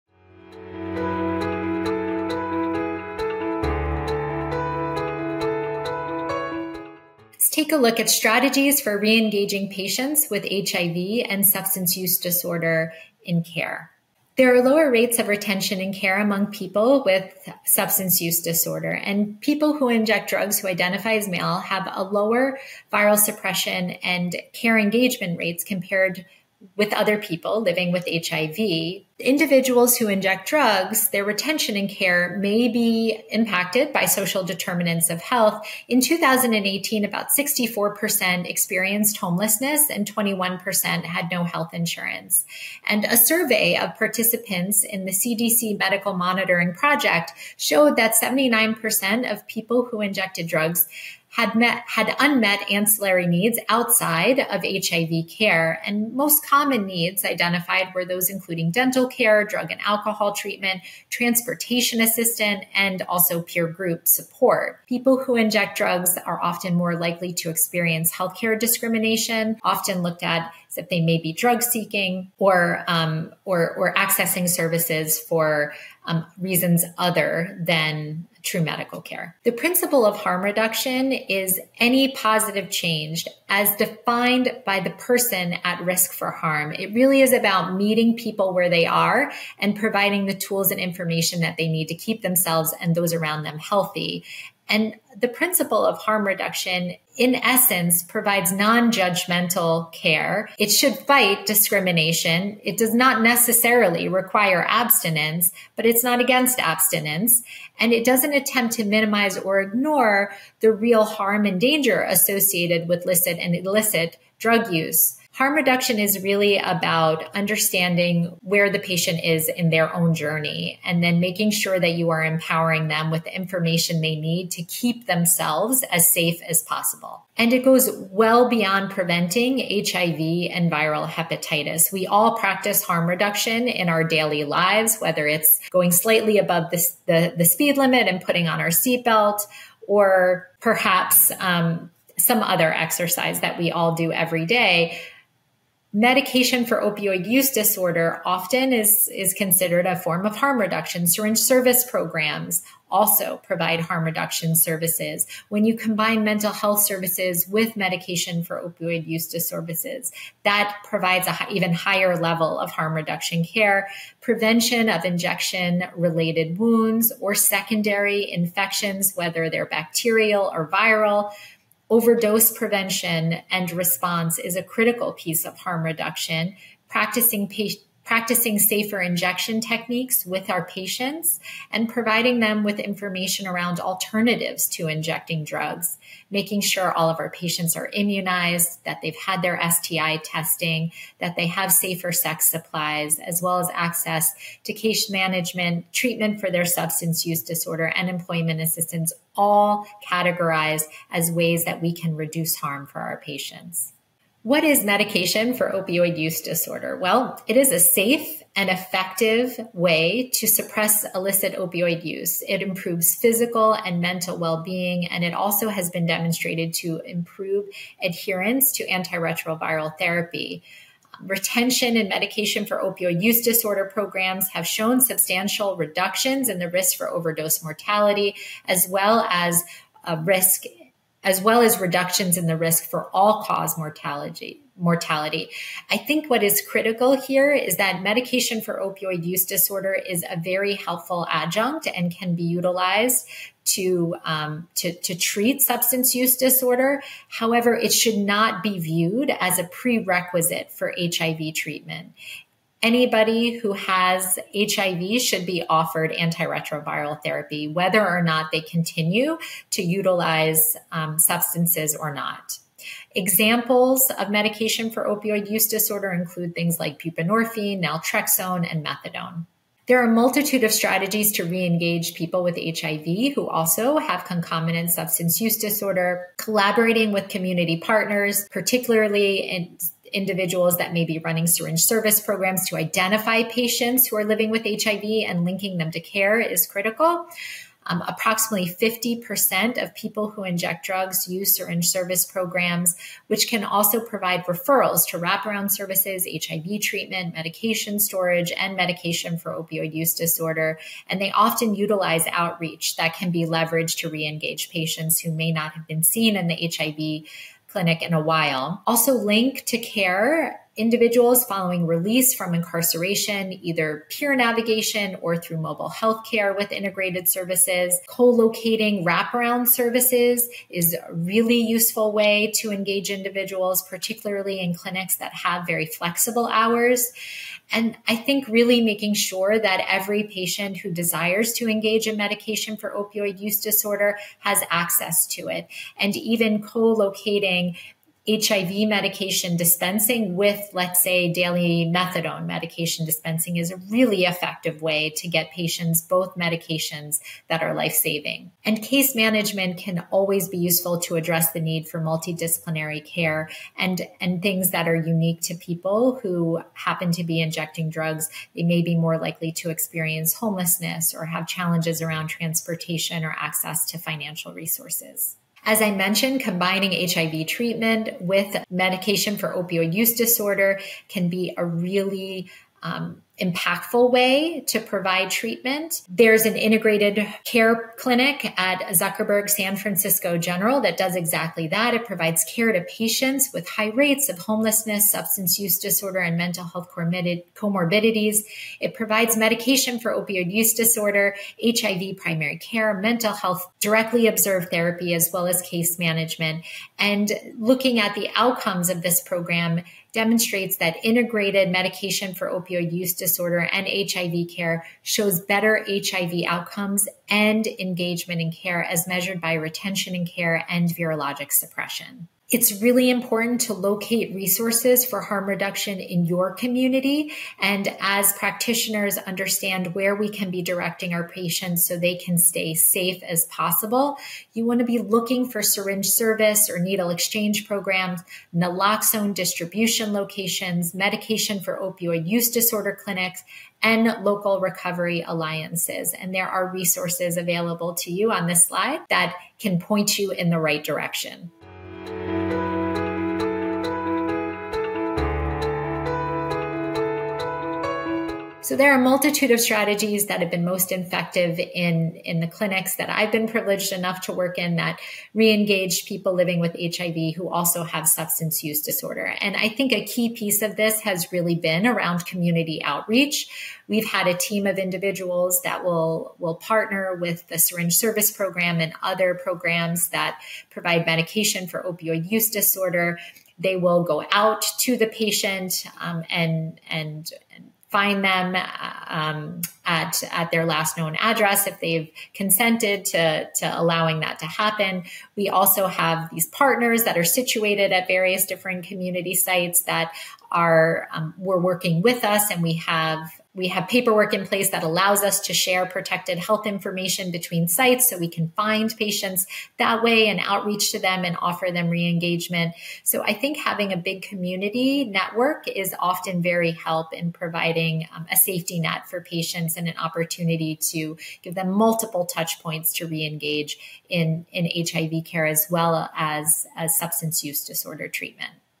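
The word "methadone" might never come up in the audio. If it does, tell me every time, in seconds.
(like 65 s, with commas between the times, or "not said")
268 s, 341 s.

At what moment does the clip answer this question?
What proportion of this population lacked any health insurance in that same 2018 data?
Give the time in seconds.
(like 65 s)
40 s.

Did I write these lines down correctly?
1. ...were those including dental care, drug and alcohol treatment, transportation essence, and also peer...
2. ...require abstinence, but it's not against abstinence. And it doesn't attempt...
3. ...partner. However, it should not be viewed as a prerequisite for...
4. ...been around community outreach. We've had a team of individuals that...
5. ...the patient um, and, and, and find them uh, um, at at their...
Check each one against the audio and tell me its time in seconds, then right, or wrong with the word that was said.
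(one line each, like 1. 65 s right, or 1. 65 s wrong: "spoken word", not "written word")
1. 57 s wrong: "assistance", not "essence"
2. 104 s right
3. 246 s wrong: "disorder", not "partner"
4. 461 s right
5. 474 s right.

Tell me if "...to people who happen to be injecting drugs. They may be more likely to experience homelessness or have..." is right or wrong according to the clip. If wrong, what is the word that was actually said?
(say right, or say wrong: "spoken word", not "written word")
right.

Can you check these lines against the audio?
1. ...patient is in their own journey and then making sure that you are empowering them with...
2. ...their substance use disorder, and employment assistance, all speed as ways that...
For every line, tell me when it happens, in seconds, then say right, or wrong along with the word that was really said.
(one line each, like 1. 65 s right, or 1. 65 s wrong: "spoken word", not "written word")
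1. 118 s right
2. 196 s wrong: "categorized", not "speed".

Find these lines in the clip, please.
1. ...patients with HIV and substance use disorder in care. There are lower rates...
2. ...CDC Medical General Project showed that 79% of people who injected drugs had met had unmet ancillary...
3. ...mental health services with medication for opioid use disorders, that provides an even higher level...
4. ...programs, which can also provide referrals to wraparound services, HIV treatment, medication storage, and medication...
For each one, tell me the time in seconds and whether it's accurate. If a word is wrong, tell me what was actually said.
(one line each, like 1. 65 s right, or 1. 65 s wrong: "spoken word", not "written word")
1. 9 s right
2. 45 s wrong: "Monitoring", not "General"
3. 156 s right
4. 292 s right.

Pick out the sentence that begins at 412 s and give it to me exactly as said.
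It's really important to locate resources for harm reduction in your community.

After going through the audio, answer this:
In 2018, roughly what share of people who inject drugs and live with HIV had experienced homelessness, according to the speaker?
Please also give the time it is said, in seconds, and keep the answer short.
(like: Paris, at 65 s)
64%, at 37 s.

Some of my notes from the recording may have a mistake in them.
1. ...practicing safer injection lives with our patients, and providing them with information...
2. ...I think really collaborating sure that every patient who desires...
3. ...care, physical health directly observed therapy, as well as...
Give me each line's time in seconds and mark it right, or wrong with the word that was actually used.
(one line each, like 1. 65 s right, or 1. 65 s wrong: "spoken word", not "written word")
1. 178 s wrong: "techniques", not "lives"
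2. 328 s wrong: "making", not "collaborating"
3. 392 s wrong: "mental", not "physical".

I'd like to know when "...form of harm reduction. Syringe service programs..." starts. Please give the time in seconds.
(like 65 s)
149 s.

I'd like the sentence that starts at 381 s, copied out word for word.
It provides care to patients with high rates of homelessness, substance use disorder, and mental health comorbidities.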